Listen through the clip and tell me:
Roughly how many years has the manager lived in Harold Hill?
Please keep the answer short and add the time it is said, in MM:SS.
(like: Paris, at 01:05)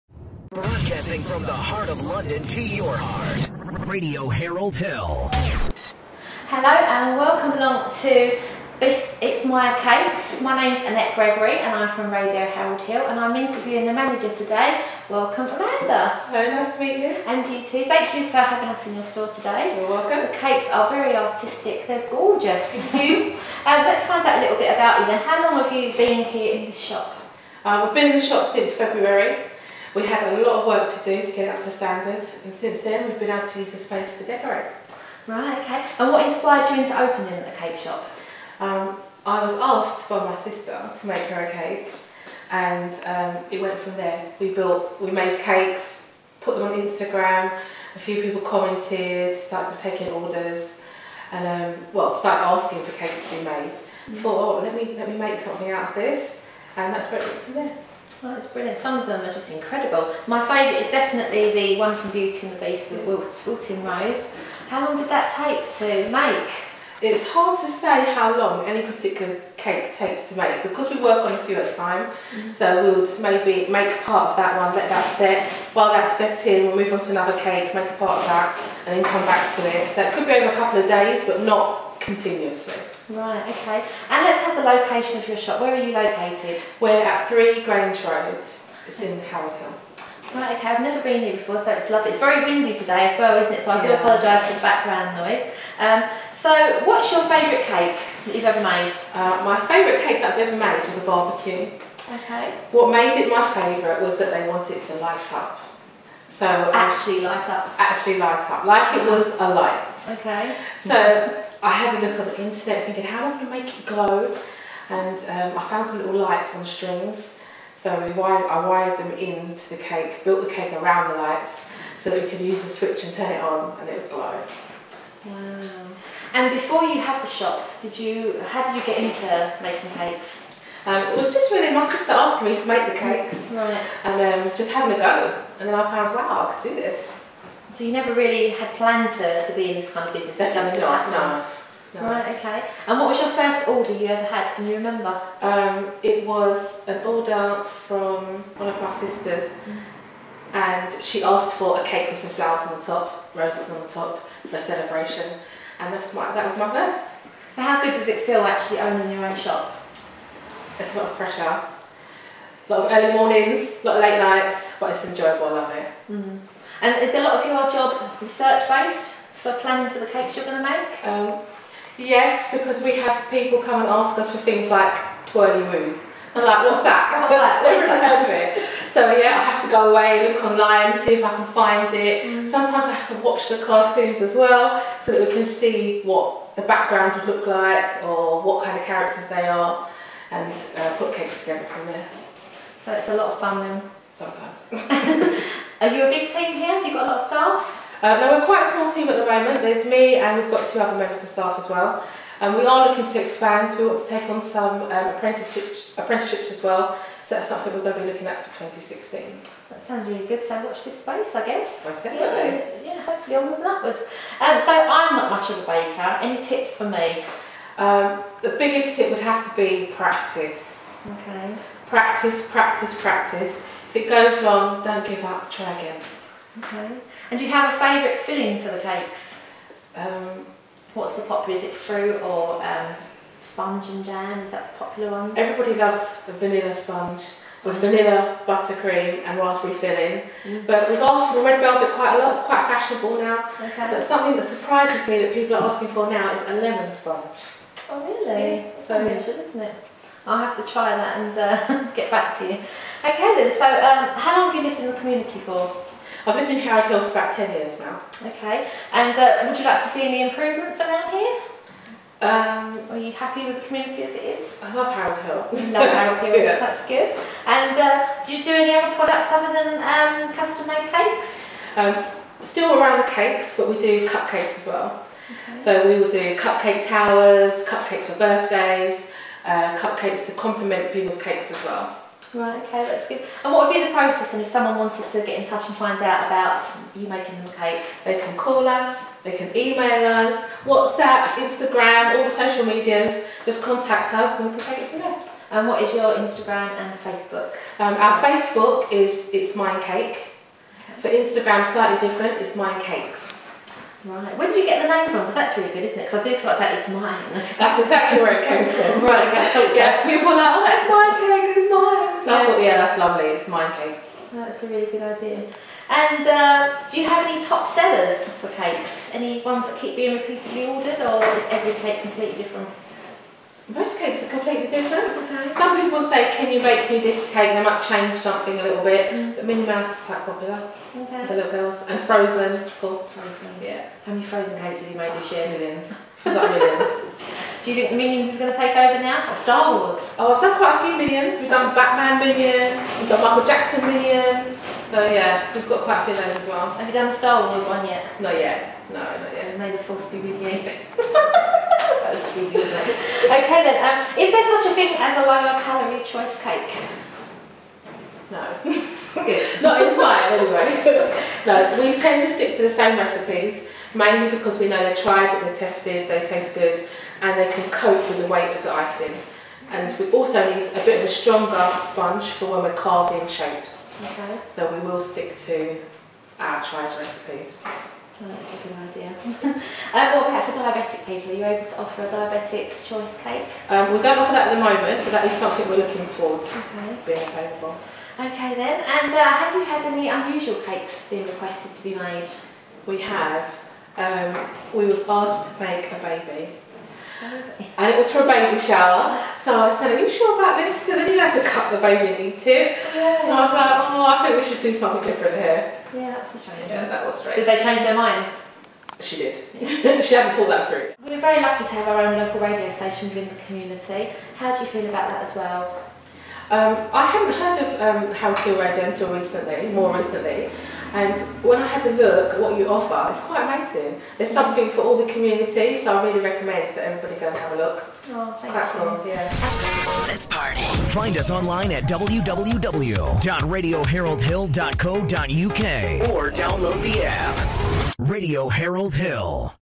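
10 years, at 04:17.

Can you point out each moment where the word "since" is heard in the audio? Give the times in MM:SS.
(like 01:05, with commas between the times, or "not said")
00:28, 00:32.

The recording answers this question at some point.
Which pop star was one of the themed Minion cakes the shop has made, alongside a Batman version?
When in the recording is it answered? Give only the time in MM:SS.
05:43.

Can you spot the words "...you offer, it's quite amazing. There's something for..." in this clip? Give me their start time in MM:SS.
07:02.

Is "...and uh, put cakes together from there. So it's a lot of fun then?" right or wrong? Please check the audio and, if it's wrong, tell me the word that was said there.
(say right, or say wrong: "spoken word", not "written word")
right.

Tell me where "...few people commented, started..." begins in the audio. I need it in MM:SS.
00:47.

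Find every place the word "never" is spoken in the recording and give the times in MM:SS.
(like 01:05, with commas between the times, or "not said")
01:30, 02:17, 02:57.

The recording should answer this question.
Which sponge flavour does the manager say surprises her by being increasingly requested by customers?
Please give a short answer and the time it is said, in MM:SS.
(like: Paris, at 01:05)
Lemon, at 04:06.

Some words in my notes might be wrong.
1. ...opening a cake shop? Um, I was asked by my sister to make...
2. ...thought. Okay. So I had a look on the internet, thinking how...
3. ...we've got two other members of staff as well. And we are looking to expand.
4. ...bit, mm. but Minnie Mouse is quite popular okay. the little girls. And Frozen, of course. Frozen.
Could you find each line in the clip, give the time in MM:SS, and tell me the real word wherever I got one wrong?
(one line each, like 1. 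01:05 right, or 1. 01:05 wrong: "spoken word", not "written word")
1. 00:36 right
2. 01:49 wrong: "light", not "thought"
3. 03:20 right
4. 05:28 right.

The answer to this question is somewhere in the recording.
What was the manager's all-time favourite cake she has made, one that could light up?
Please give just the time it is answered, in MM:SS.
01:40.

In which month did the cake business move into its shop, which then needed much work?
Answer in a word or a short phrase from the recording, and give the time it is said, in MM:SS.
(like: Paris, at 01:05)
February, at 00:28.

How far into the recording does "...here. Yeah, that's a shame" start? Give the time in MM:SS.
06:45.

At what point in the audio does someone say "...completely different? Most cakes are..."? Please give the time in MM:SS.
05:22.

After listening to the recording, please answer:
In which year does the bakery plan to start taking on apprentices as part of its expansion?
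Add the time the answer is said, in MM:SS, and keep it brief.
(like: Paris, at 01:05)
2016, at 03:28.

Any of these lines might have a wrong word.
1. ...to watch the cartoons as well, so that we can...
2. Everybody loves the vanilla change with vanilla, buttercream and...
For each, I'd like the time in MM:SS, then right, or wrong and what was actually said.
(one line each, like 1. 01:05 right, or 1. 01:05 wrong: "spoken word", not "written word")
1. 03:03 right
2. 03:55 wrong: "sponge", not "change".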